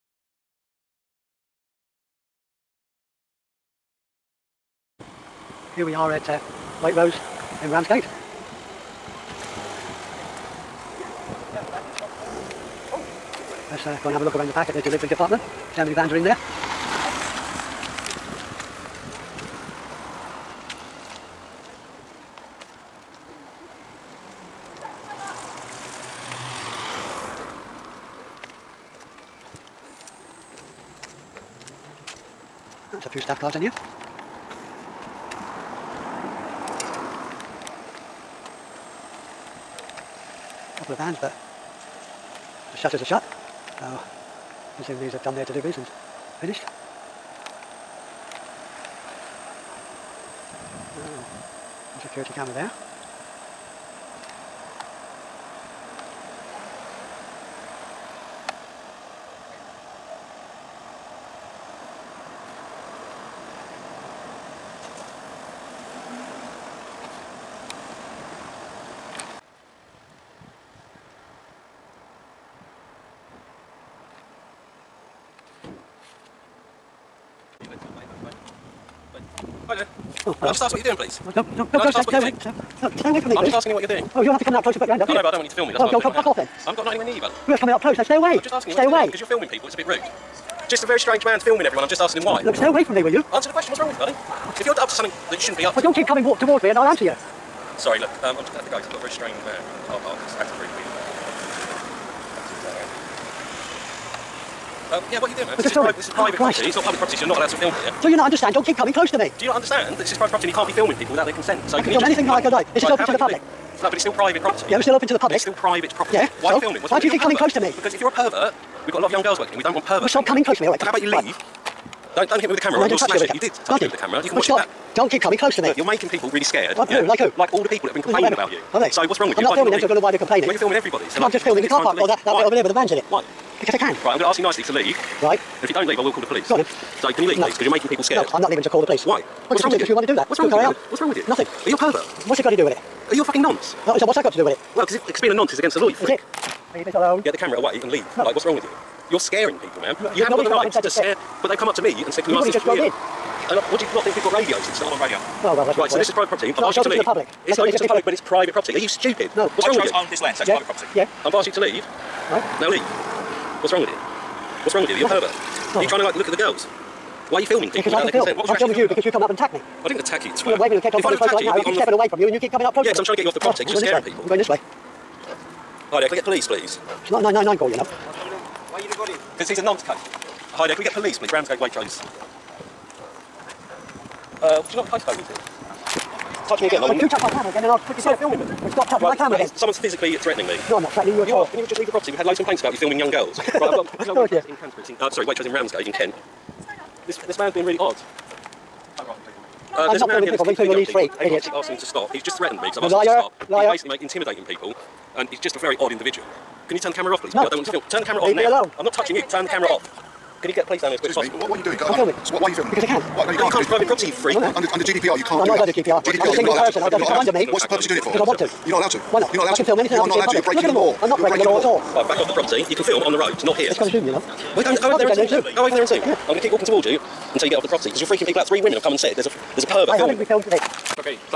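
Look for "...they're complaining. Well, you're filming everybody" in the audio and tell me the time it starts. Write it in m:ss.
2:10.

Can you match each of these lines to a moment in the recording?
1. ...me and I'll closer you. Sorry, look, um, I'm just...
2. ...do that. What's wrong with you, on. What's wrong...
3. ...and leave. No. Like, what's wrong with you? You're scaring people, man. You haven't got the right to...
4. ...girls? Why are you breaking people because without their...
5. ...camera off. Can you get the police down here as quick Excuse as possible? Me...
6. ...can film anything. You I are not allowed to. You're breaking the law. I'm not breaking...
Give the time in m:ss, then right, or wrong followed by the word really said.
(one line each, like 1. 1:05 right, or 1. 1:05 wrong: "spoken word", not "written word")
1. 1:36 wrong: "answer", not "closer"
2. 2:20 right
3. 2:27 right
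4. 2:46 wrong: "filming", not "breaking"
5. 3:29 right
6. 3:39 right.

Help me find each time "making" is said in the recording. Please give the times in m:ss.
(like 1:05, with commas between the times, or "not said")
2:05, 2:17.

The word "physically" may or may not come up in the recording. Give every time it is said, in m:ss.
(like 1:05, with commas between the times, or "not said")
3:09.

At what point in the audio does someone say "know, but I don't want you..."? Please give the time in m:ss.
1:25.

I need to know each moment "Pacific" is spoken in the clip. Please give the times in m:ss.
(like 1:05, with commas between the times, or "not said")
not said.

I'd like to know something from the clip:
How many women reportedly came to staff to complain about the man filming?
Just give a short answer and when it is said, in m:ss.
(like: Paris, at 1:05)
3, at 3:48.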